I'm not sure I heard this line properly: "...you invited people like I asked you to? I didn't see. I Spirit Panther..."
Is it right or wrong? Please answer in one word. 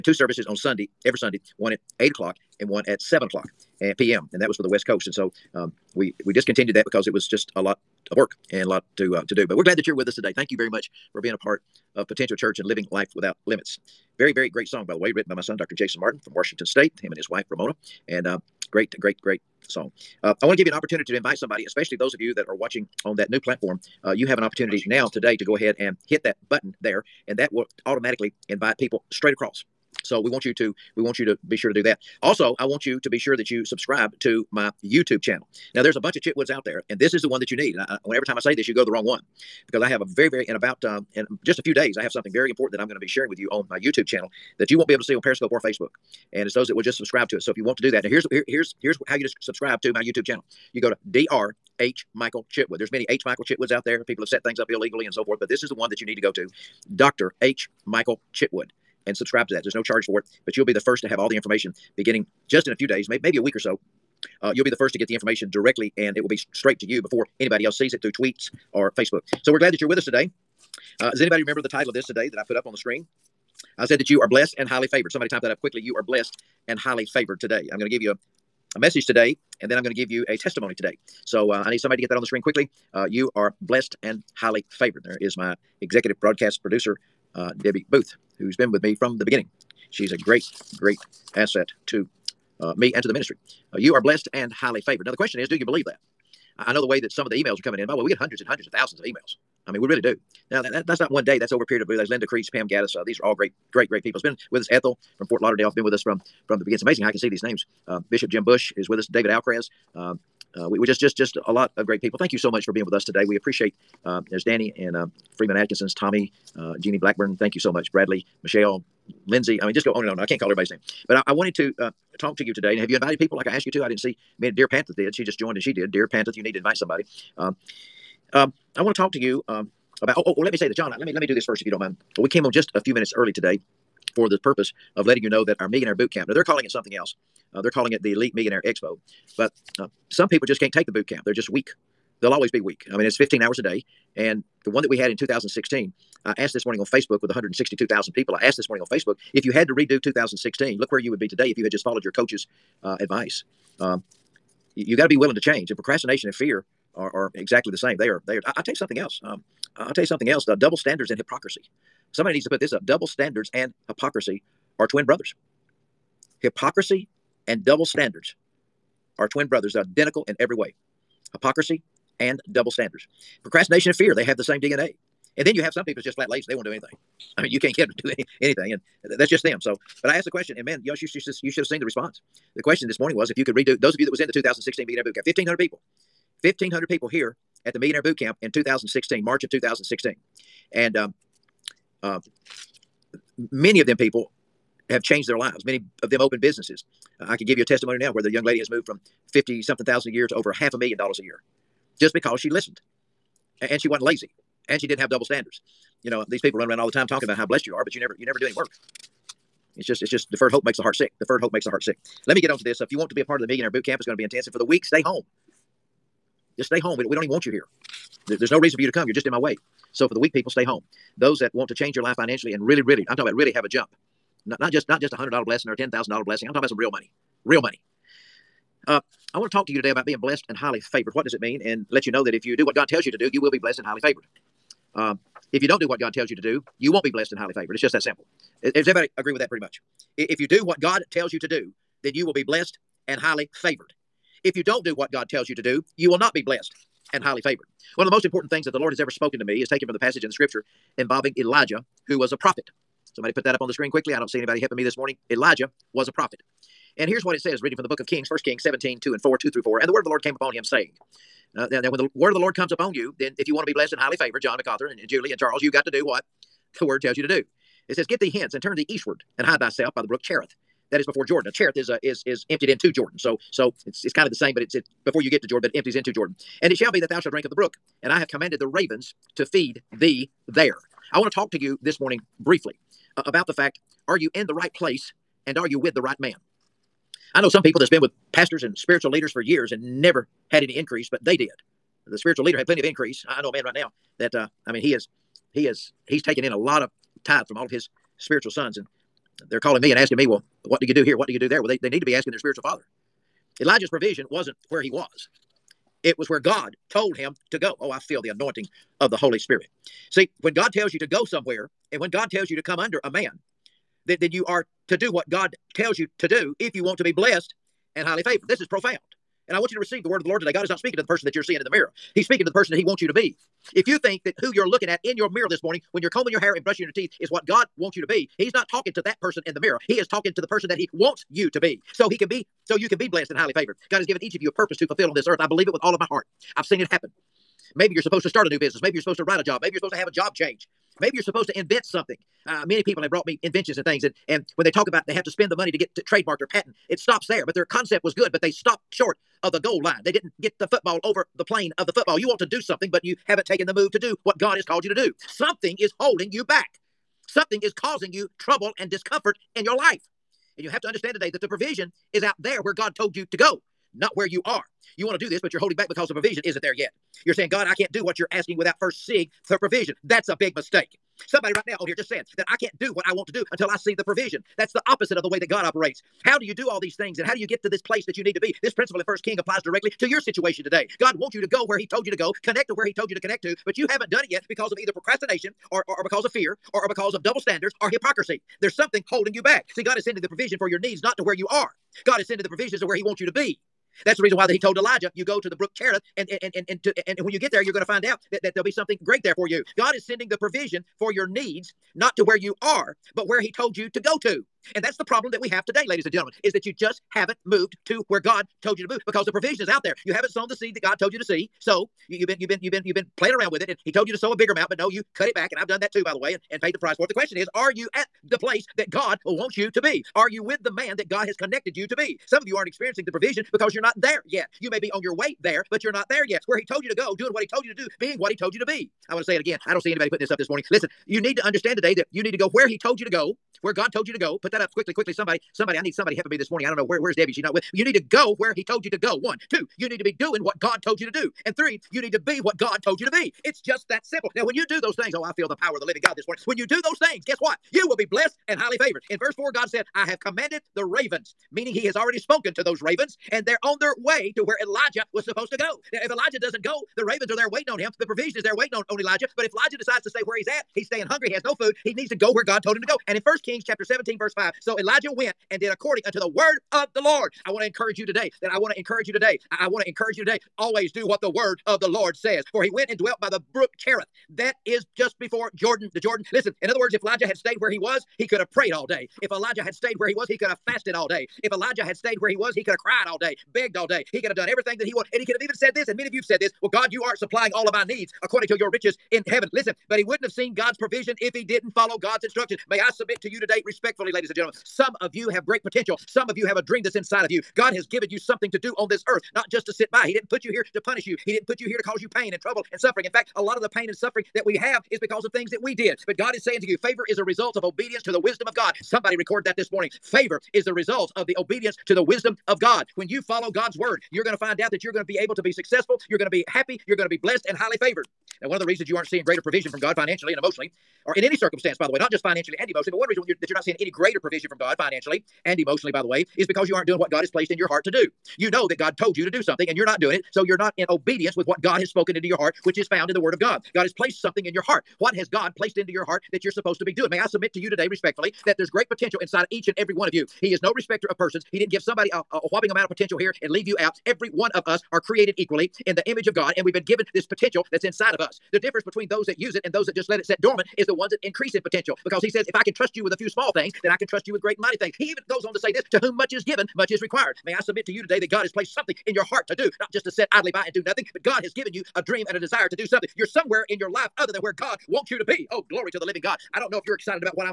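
wrong.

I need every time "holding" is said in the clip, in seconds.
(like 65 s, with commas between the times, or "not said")
355 s, 365 s, 389 s.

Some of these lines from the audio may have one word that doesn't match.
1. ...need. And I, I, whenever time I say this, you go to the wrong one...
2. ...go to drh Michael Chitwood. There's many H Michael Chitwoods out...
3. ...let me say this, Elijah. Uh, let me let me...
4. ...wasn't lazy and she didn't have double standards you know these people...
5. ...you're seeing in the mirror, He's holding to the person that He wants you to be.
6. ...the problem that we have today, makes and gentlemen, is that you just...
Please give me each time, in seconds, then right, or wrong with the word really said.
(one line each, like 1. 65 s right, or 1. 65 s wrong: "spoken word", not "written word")
1. 37 s right
2. 50 s right
3. 130 s wrong: "John", not "Elijah"
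4. 203 s right
5. 321 s wrong: "speaking", not "holding"
6. 404 s wrong: "ladies", not "makes".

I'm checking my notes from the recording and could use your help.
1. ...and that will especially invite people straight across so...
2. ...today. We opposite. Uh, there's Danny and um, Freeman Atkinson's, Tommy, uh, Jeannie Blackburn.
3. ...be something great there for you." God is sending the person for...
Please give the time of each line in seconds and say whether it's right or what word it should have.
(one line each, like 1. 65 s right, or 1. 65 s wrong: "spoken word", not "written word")
1. 27 s wrong: "automatically", not "especially"
2. 113 s wrong: "appreciate", not "opposite"
3. 398 s wrong: "provision", not "person".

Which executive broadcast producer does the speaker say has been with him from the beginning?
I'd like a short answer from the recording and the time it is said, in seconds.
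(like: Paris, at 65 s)
Debbie Booth, at 87 s.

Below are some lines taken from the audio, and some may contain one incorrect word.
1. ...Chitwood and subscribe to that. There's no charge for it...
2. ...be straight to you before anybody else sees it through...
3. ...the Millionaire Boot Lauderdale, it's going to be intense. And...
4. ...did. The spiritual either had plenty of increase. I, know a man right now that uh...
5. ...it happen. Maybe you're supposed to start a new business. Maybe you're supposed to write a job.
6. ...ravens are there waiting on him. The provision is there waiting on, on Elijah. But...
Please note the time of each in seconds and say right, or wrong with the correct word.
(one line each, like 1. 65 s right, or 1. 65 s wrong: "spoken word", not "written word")
1. 58 s right
2. 66 s right
3. 213 s wrong: "Camp", not "Lauderdale"
4. 291 s wrong: "leader", not "either"
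5. 336 s right
6. 457 s right.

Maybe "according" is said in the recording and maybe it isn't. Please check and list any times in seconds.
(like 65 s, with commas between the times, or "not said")
465 s, 488 s.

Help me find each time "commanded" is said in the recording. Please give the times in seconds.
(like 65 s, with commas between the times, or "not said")
278 s, 450 s.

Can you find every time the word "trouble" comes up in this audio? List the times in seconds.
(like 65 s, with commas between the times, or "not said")
358 s, 502 s.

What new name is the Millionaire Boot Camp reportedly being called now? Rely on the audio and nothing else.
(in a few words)
Elite Millionaire Expo.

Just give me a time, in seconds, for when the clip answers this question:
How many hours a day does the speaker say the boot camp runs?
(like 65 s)
143 s.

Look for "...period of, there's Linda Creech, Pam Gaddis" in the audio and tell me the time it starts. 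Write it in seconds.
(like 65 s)
101 s.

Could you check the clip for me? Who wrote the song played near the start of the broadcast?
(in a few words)
Dr. Jason Martin.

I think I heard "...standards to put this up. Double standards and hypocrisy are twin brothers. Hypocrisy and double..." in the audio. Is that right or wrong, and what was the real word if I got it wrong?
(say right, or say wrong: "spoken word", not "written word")
wrong: "needs", not "standards".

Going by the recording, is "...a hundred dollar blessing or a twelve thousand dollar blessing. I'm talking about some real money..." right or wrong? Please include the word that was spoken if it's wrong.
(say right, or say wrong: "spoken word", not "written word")
wrong: "ten", not "twelve".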